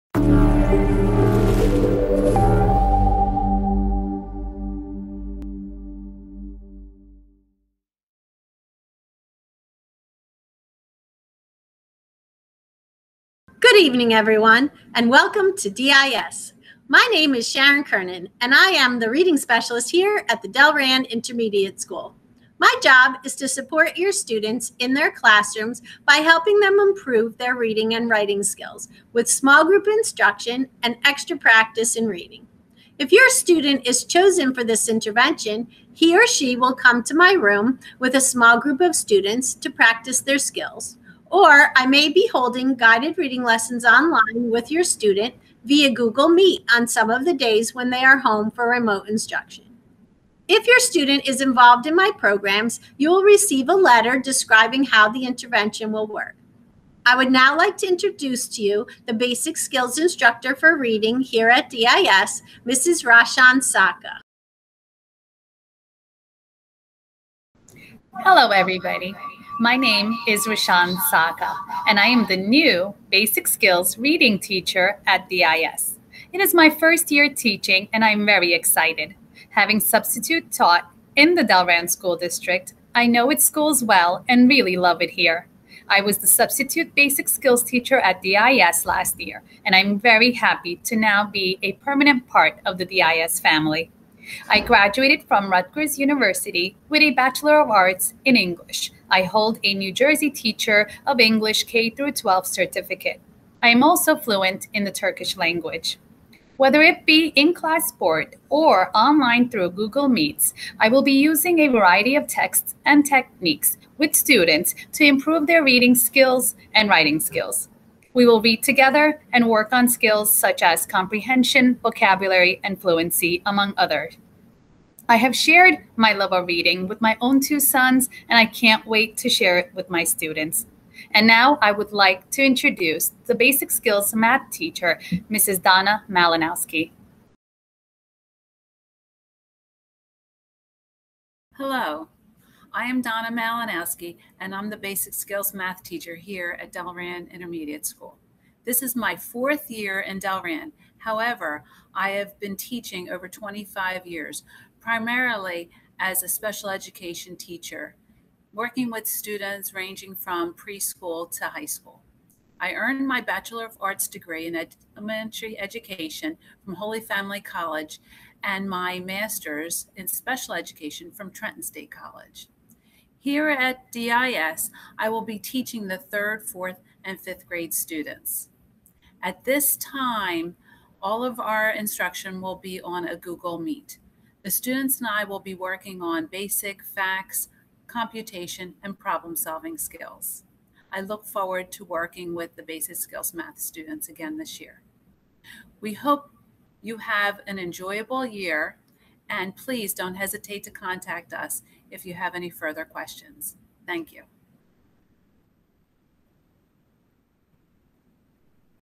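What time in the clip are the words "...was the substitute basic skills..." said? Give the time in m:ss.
1:26.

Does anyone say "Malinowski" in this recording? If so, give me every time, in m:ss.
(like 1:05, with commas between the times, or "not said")
2:16, 2:23.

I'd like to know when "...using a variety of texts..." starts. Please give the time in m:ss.
1:51.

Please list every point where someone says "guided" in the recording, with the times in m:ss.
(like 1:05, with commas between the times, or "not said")
0:42.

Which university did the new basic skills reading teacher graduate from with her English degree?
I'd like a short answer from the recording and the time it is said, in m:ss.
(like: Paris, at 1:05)
Rutgers University, at 1:35.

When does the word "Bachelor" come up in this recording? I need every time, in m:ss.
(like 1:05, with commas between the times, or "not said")
1:37, 2:43.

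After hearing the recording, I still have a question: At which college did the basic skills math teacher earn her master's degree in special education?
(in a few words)
Trenton State College.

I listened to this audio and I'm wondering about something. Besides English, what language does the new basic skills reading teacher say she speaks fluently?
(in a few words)
Turkish.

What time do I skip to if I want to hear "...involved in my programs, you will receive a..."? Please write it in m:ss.
0:51.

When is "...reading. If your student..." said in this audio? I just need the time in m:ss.
0:32.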